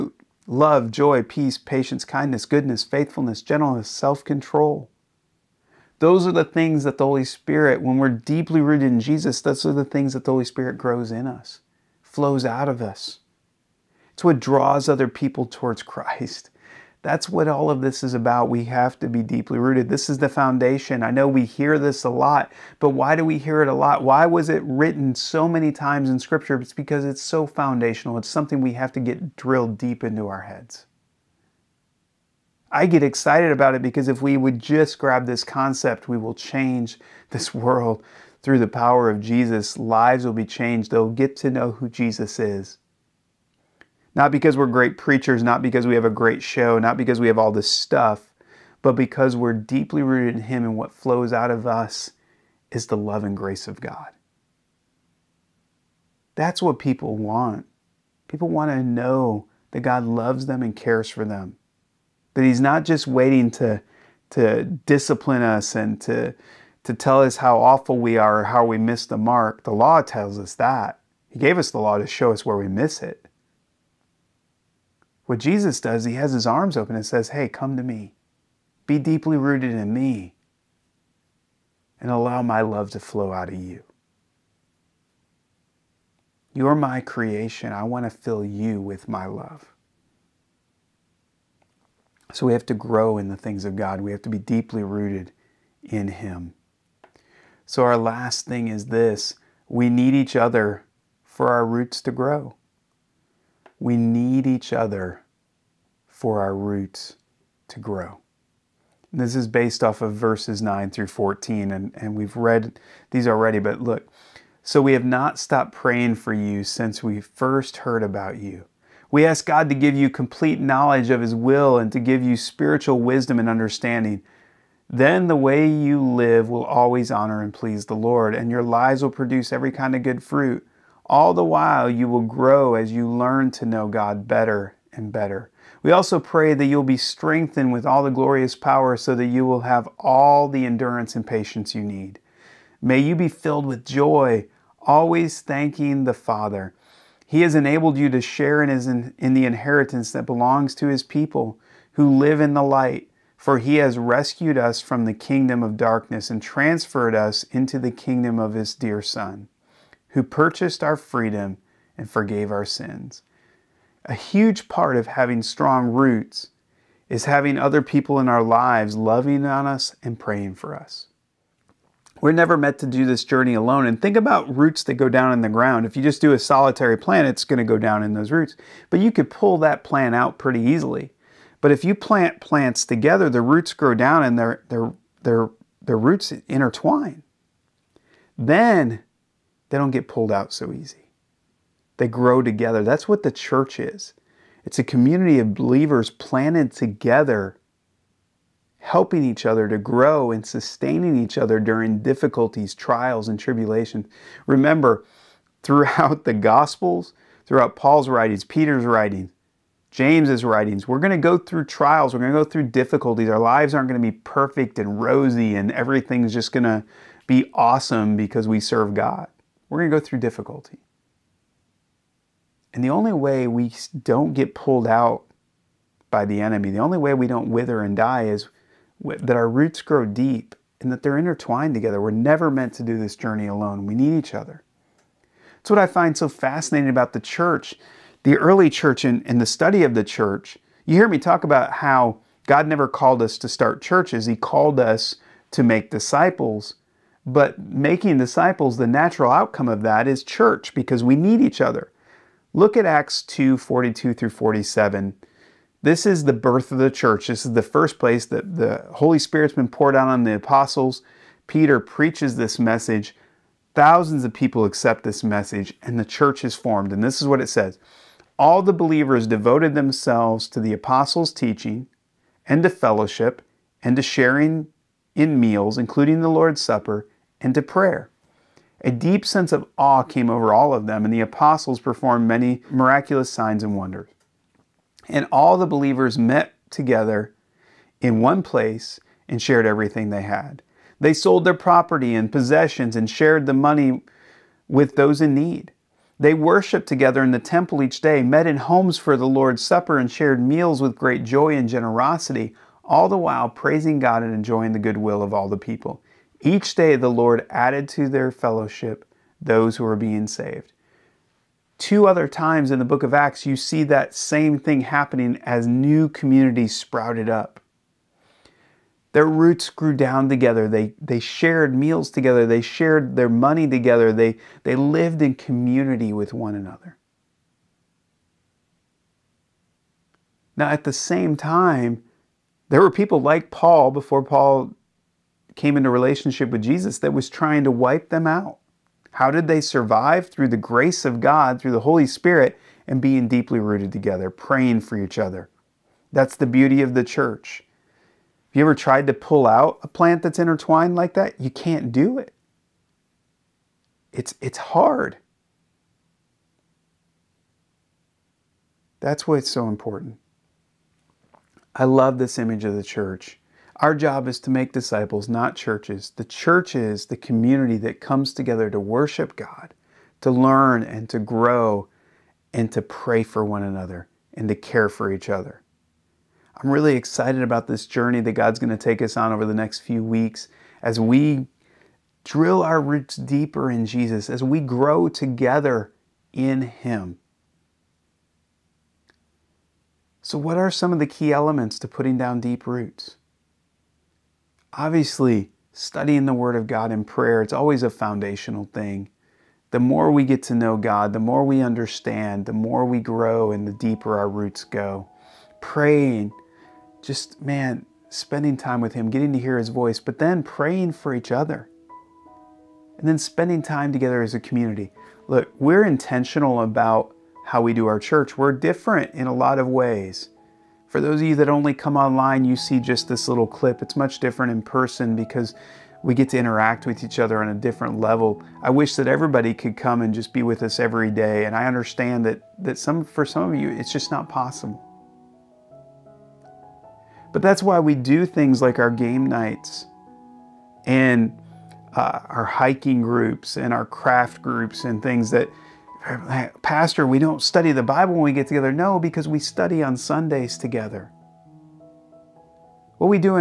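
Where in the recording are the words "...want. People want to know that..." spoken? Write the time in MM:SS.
00:57.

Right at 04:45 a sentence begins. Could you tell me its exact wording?
And all the believers met together in one place and shared everything they had.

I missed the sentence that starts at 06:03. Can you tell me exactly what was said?
Our job is to make disciples, not churches.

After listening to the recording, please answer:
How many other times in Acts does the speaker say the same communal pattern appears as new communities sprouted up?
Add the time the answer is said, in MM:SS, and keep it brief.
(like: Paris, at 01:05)
2, at 05:11.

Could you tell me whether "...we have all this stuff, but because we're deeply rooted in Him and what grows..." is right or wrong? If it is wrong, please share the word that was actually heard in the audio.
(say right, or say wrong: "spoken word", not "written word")
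wrong: "flows", not "grows".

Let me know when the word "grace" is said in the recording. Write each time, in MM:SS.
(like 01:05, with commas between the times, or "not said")
00:53, 05:40.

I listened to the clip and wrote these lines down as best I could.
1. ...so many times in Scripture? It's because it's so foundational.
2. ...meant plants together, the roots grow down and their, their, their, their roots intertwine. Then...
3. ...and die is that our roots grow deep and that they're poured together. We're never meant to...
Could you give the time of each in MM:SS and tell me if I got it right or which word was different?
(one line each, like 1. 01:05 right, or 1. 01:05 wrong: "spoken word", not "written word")
1. 00:25 right
2. 03:01 wrong: "plant", not "meant"
3. 03:47 wrong: "intertwined", not "poured".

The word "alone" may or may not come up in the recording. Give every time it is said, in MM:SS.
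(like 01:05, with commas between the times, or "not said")
02:53, 03:53.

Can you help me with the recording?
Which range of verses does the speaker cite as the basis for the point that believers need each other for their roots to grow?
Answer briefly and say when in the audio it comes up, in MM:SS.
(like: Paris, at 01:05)
verses 9 through 14, at 01:50.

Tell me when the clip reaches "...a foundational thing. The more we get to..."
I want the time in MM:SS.
06:37.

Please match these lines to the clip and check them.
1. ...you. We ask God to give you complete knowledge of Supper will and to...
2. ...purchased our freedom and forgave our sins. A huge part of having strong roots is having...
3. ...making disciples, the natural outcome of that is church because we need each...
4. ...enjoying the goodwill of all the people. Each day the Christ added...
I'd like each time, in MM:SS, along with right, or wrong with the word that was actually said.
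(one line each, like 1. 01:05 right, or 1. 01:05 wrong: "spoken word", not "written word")
1. 01:58 wrong: "His", not "Supper"
2. 02:40 right
3. 04:07 right
4. 05:04 wrong: "Lord", not "Christ".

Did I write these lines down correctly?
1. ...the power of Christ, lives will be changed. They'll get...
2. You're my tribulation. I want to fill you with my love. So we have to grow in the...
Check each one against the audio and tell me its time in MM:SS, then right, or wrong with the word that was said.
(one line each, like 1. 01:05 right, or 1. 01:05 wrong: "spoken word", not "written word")
1. 00:38 wrong: "Jesus", not "Christ"
2. 01:26 wrong: "creation", not "tribulation".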